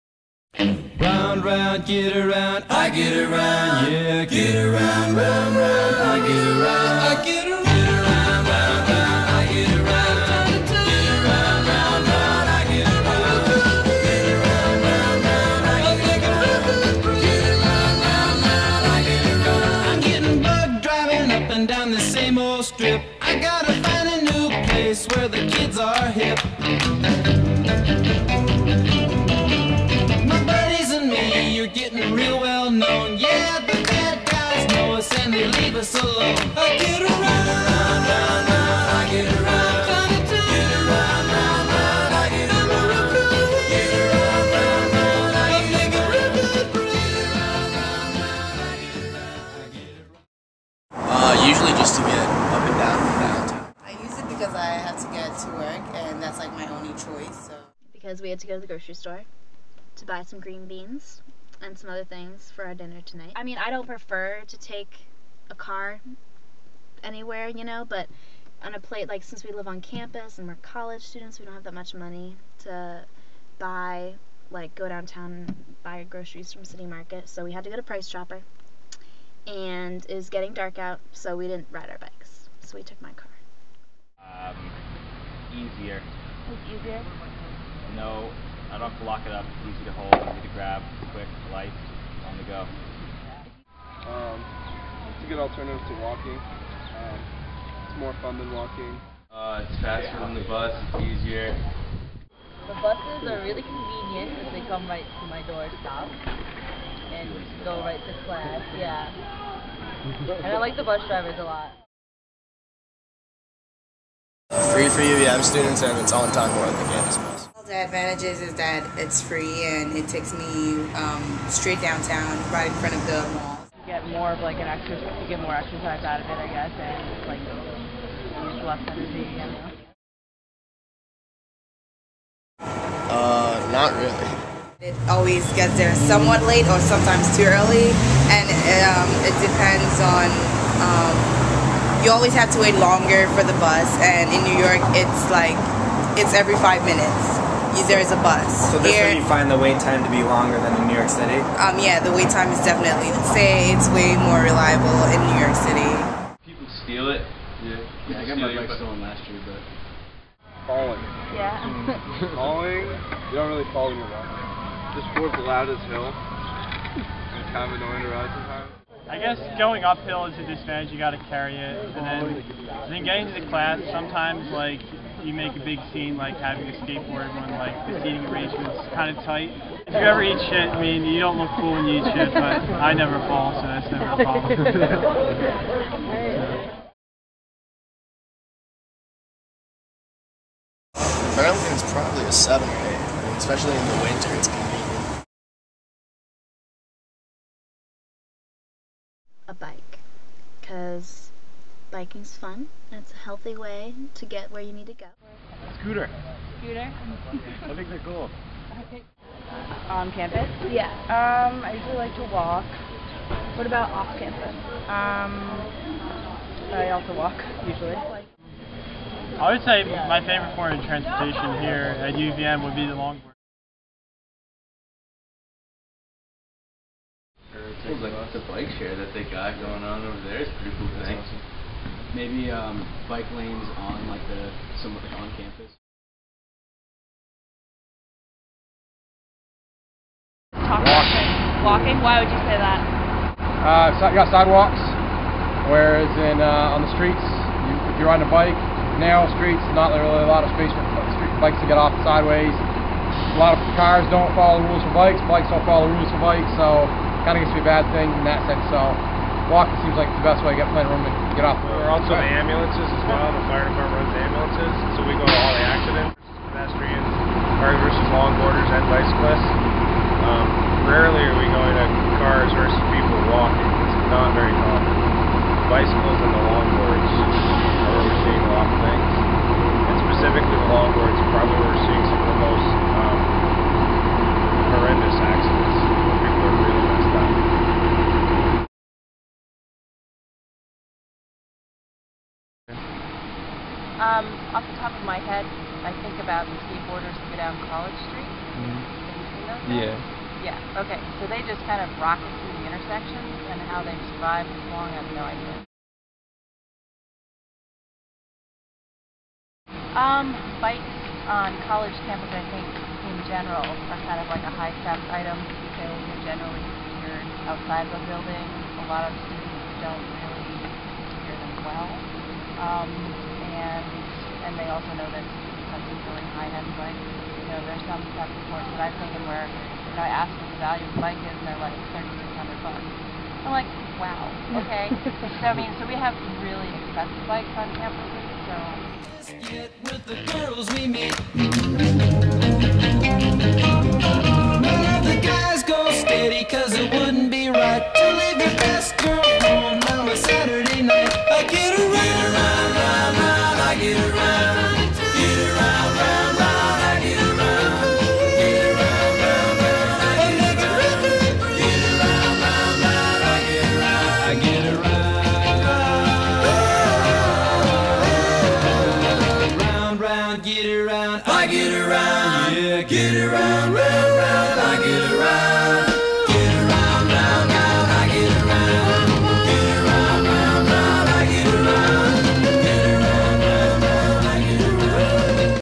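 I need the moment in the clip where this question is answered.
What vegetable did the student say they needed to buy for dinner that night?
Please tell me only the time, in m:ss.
1:00.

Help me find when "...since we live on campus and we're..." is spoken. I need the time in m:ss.
1:09.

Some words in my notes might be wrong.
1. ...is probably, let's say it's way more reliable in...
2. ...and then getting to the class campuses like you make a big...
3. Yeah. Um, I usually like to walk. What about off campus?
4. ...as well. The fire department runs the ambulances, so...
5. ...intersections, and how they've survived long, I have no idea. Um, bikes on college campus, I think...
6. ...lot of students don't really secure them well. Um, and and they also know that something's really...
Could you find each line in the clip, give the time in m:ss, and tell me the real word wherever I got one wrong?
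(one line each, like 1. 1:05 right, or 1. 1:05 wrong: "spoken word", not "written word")
1. 2:32 wrong: "definitely", not "probably"
2. 2:52 wrong: "sometimes", not "campuses"
3. 3:30 right
4. 4:22 right
5. 5:02 right
6. 5:18 right.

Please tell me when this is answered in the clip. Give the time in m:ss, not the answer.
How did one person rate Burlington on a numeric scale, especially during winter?
3:12.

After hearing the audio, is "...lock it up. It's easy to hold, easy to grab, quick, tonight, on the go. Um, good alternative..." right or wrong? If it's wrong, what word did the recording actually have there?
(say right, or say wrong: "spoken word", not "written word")
wrong: "light", not "tonight".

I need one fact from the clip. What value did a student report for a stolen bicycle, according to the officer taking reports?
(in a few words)
$3,600.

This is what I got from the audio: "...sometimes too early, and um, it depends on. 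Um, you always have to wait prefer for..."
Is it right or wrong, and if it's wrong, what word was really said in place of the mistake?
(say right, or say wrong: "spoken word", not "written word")
wrong: "longer", not "prefer".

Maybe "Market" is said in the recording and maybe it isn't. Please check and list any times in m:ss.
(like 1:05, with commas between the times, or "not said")
1:16.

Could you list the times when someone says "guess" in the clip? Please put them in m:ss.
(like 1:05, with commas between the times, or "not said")
2:06, 2:49.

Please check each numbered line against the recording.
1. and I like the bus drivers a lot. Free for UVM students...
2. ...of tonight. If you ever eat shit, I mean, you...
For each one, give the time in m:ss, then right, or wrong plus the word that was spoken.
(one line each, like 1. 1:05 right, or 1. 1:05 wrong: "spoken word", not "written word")
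1. 1:50 right
2. 2:59 wrong: "tight", not "tonight".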